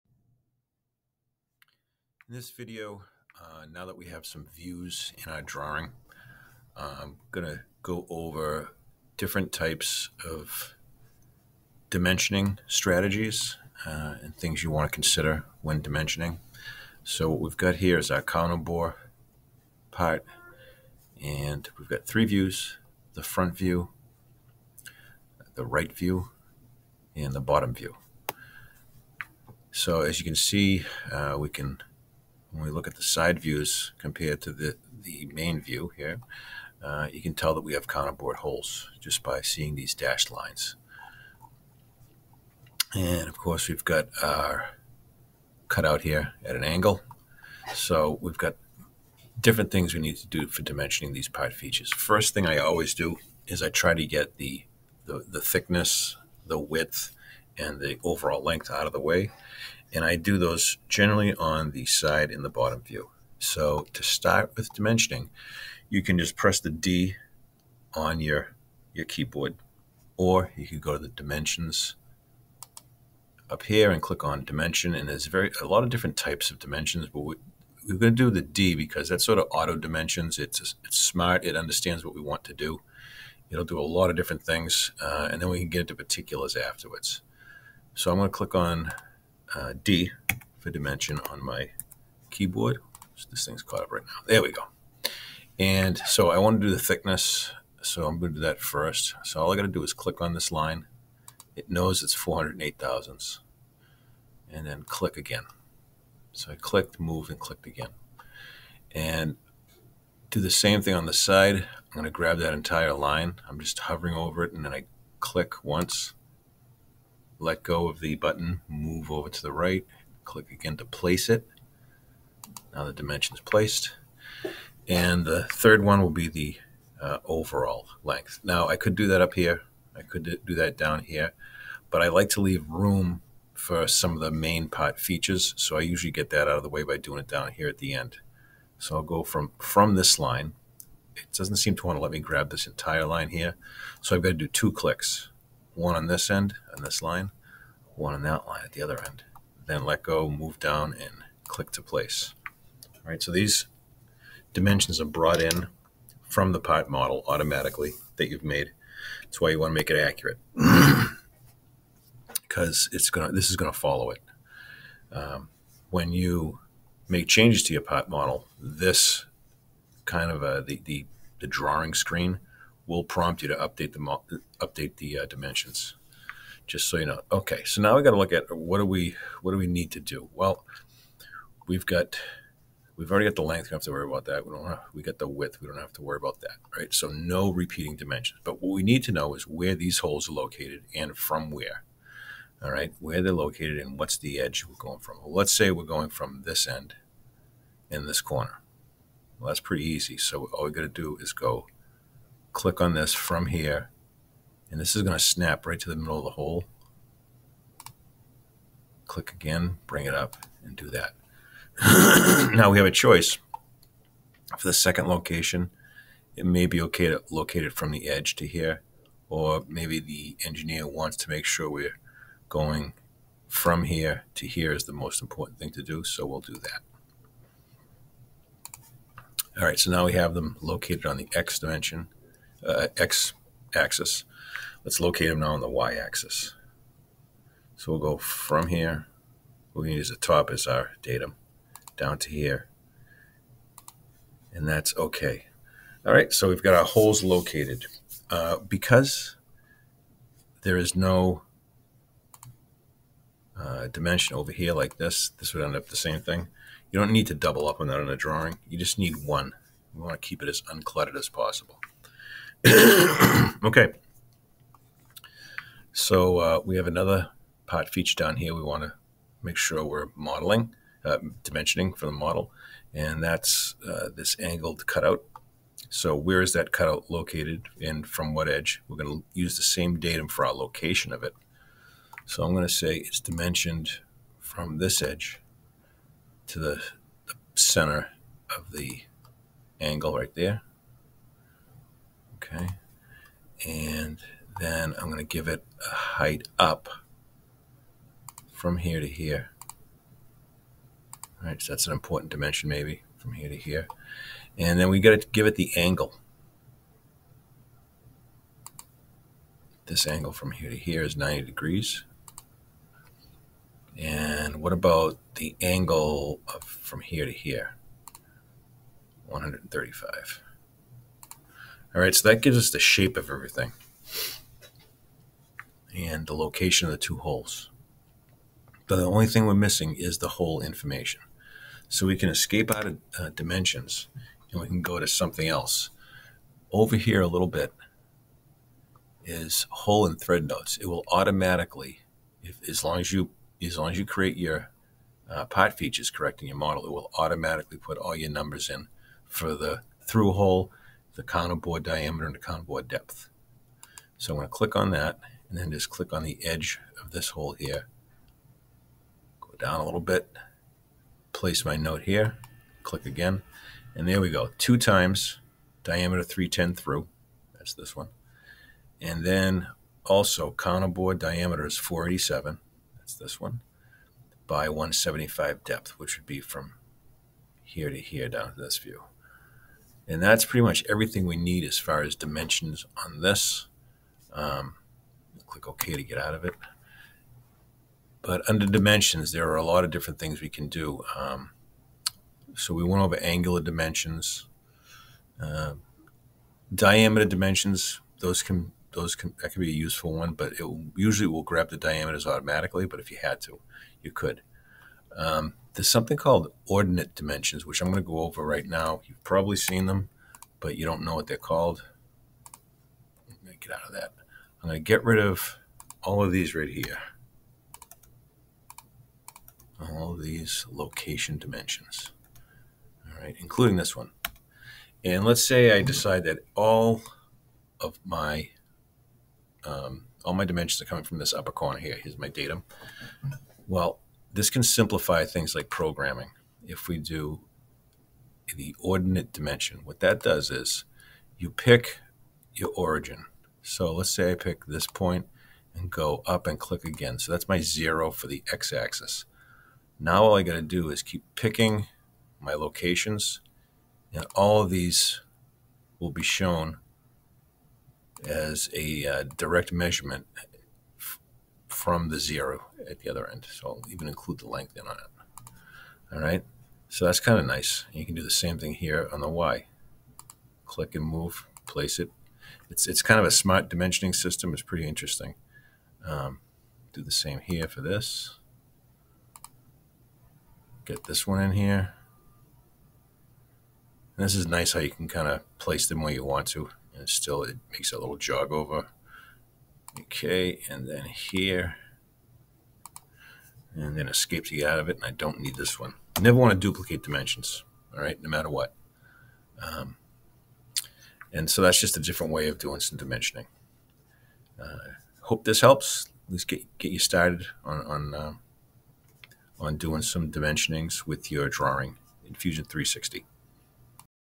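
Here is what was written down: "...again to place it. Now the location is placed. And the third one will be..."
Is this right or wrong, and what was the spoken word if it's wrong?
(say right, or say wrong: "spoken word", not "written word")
wrong: "dimension", not "location".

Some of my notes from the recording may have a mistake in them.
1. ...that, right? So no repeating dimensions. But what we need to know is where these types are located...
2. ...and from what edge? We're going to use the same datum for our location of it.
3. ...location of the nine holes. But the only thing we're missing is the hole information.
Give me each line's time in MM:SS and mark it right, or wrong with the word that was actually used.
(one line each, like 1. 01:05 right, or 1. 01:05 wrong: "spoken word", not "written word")
1. 03:06 wrong: "holes", not "types"
2. 04:37 right
3. 05:26 wrong: "two", not "nine".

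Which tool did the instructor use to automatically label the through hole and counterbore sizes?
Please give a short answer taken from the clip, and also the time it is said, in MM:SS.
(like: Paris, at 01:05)
Hole and thread notes, at 05:39.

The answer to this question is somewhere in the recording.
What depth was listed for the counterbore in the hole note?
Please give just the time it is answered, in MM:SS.
06:14.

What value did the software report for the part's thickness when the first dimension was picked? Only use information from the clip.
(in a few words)
408 thousandths.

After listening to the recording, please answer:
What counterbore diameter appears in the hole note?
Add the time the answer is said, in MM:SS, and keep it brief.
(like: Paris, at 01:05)
487, at 06:11.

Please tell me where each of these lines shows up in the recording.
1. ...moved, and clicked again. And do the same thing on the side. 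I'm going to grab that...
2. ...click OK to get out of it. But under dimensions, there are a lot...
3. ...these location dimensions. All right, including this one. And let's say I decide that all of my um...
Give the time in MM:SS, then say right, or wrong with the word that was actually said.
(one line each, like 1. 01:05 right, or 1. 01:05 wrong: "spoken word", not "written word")
1. 01:46 right
2. 06:25 right
3. 07:00 right.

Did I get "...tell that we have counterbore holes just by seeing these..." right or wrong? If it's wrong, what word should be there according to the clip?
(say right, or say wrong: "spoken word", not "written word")
right.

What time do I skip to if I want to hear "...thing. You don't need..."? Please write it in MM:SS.
04:16.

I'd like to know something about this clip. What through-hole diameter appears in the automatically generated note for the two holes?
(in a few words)
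310.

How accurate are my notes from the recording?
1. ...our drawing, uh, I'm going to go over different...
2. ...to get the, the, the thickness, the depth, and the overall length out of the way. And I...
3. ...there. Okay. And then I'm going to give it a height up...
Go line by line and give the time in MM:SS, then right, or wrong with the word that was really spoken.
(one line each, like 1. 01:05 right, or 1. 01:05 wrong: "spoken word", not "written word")
1. 00:05 right
2. 00:53 wrong: "width", not "depth"
3. 04:50 right.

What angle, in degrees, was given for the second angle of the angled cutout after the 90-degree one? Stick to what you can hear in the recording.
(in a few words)
135.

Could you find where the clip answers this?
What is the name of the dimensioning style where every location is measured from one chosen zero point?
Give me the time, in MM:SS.
06:46.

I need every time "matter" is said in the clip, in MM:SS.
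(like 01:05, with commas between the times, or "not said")
08:18.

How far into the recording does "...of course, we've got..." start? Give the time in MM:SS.
00:43.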